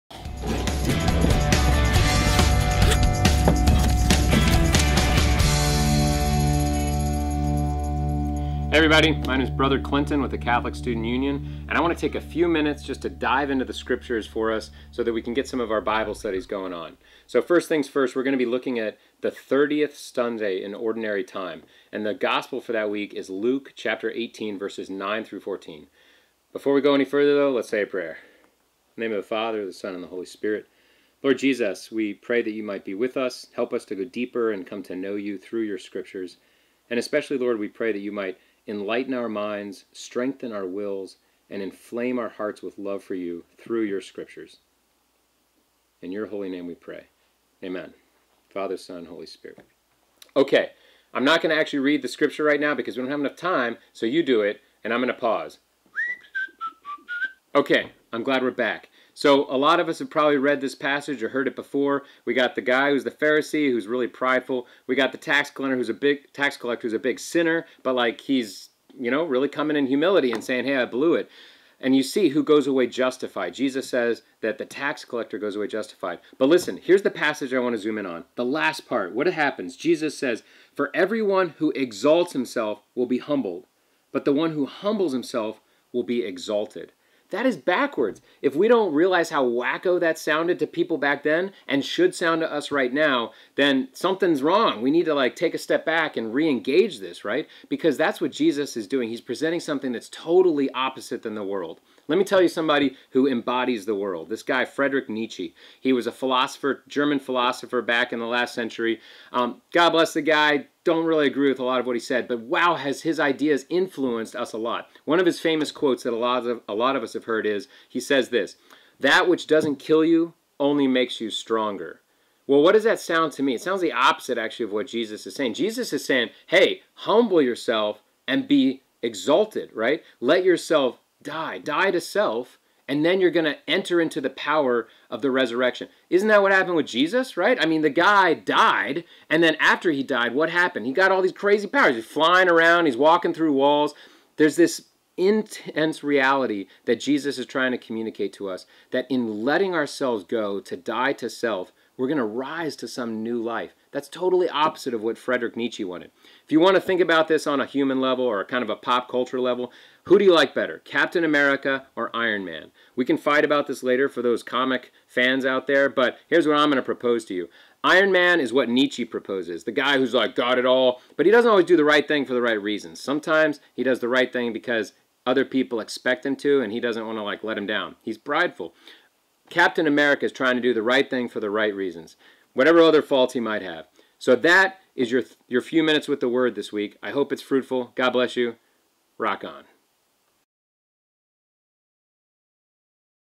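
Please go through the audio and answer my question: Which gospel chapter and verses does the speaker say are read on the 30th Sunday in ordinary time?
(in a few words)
Luke 18:9-14.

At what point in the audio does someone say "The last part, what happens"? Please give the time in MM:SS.
01:18.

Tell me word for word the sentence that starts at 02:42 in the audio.
We can fight about this later for those comic fans out there, but here's what I'm going to propose to you.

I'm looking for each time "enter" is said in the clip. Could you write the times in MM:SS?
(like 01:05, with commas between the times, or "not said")
02:13.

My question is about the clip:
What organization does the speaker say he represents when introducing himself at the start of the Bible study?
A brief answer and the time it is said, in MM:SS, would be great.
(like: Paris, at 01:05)
Catholic Student Union, at 00:10.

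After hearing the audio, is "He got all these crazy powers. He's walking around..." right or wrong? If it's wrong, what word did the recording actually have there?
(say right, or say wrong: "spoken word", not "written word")
wrong: "flying", not "walking".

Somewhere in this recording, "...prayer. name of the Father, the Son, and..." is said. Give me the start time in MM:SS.
00:27.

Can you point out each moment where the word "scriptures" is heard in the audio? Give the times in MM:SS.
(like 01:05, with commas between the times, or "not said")
00:13, 00:35, 00:44, 00:52.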